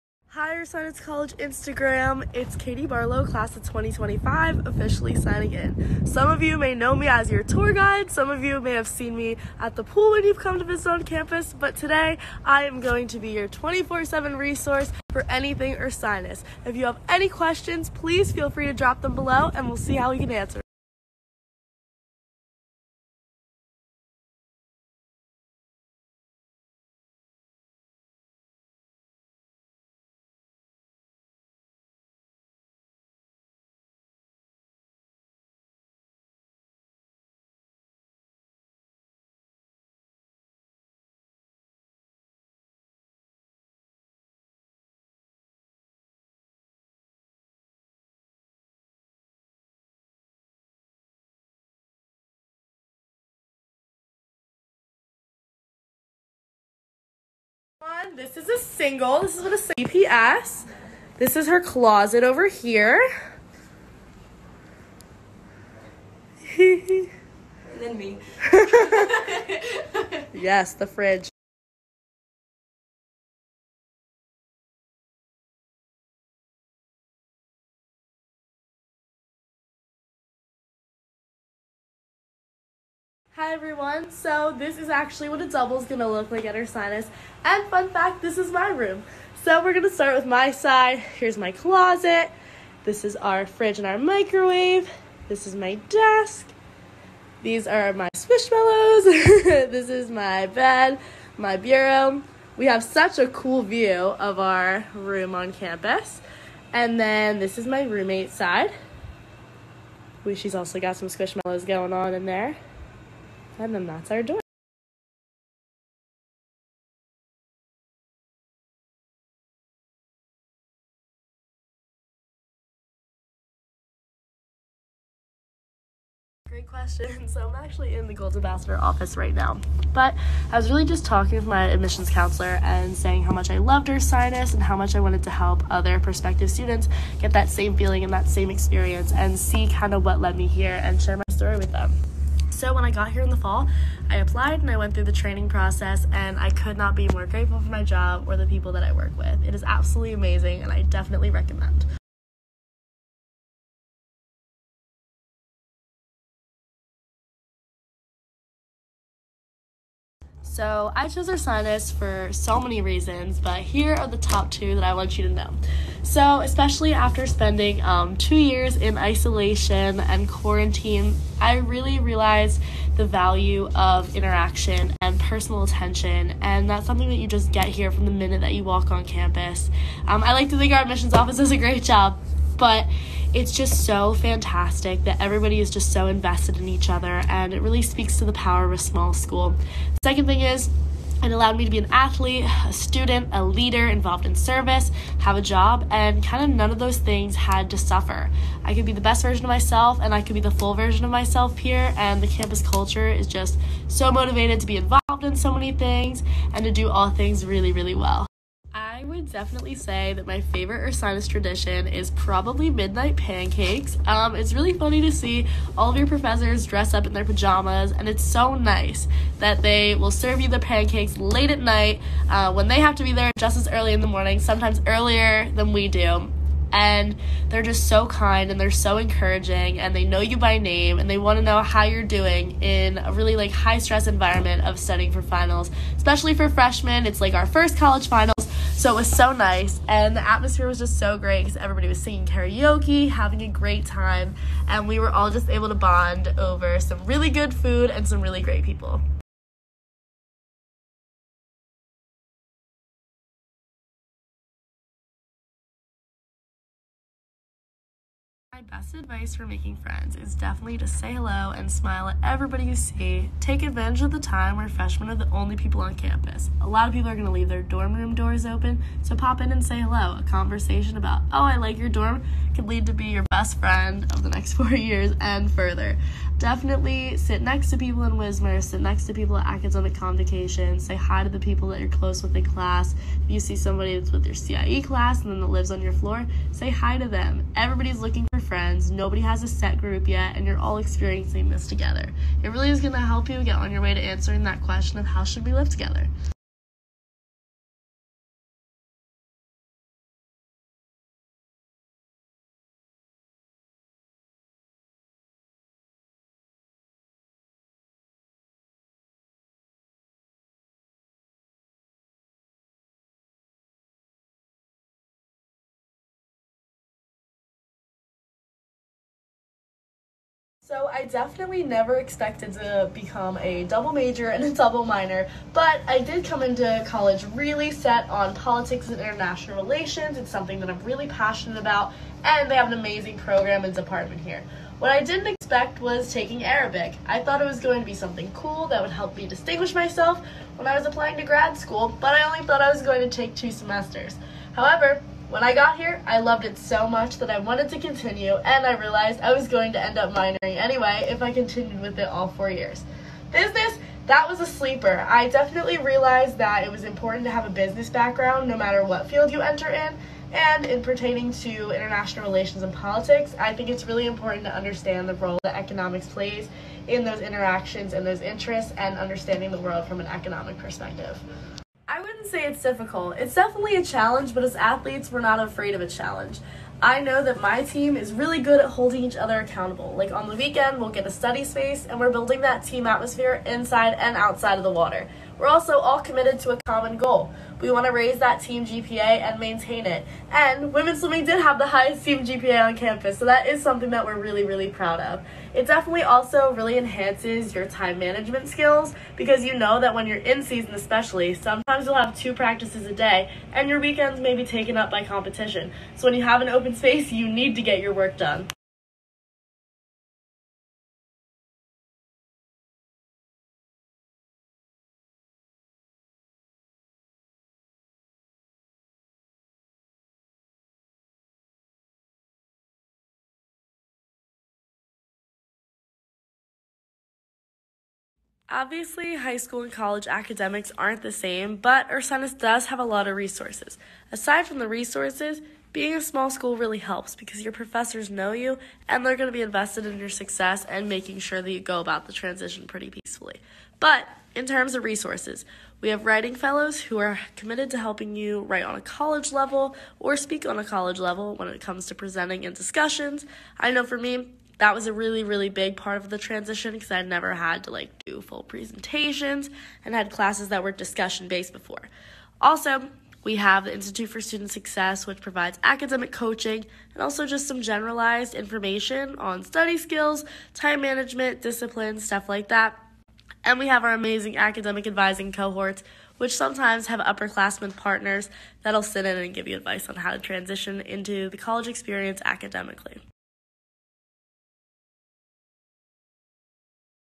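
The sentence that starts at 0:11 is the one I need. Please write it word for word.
But today, I am going to be your 24-7 resource for anything Ursinus.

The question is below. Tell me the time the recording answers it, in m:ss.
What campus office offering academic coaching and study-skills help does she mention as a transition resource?
7:43.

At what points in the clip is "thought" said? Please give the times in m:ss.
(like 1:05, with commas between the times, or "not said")
5:37, 5:42.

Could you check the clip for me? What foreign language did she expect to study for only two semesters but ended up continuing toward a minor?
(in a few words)
Arabic.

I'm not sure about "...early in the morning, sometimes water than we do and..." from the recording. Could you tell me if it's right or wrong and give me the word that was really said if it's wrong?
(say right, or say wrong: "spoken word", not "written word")
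wrong: "earlier", not "water".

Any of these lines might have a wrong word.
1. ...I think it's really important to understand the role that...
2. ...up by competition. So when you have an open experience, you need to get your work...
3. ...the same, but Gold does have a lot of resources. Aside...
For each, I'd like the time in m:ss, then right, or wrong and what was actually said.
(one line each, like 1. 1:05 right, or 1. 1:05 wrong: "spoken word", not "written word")
1. 6:03 right
2. 6:44 wrong: "space", not "experience"
3. 7:11 wrong: "Ursinus", not "Gold".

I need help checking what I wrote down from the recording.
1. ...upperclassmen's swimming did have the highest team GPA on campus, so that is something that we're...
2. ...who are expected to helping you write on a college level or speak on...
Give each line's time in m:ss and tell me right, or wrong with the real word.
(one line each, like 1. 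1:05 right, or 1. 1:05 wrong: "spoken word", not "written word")
1. 6:30 wrong: "women", not "upperclassmen"
2. 7:26 wrong: "committed", not "expected".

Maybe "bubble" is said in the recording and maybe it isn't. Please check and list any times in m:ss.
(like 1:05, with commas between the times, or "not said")
not said.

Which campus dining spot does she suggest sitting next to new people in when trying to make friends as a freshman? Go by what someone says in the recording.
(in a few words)
Wismer.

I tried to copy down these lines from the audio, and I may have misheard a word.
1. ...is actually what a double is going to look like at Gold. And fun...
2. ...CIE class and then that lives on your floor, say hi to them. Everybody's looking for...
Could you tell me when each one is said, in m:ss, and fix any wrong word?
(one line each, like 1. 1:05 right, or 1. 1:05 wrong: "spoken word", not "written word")
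1. 1:24 wrong: "Ursinus", not "Gold"
2. 4:44 right.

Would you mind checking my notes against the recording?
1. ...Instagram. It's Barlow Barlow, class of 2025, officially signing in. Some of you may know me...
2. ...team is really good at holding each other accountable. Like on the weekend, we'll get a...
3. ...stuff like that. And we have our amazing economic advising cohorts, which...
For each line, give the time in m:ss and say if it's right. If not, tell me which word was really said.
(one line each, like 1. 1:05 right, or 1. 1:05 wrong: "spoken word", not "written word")
1. 0:01 wrong: "Katie", not "Barlow"
2. 6:17 right
3. 7:51 wrong: "academic", not "economic".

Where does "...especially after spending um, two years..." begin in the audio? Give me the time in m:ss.
2:46.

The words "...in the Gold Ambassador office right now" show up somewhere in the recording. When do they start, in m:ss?
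2:07.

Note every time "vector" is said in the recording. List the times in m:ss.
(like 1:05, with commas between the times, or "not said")
not said.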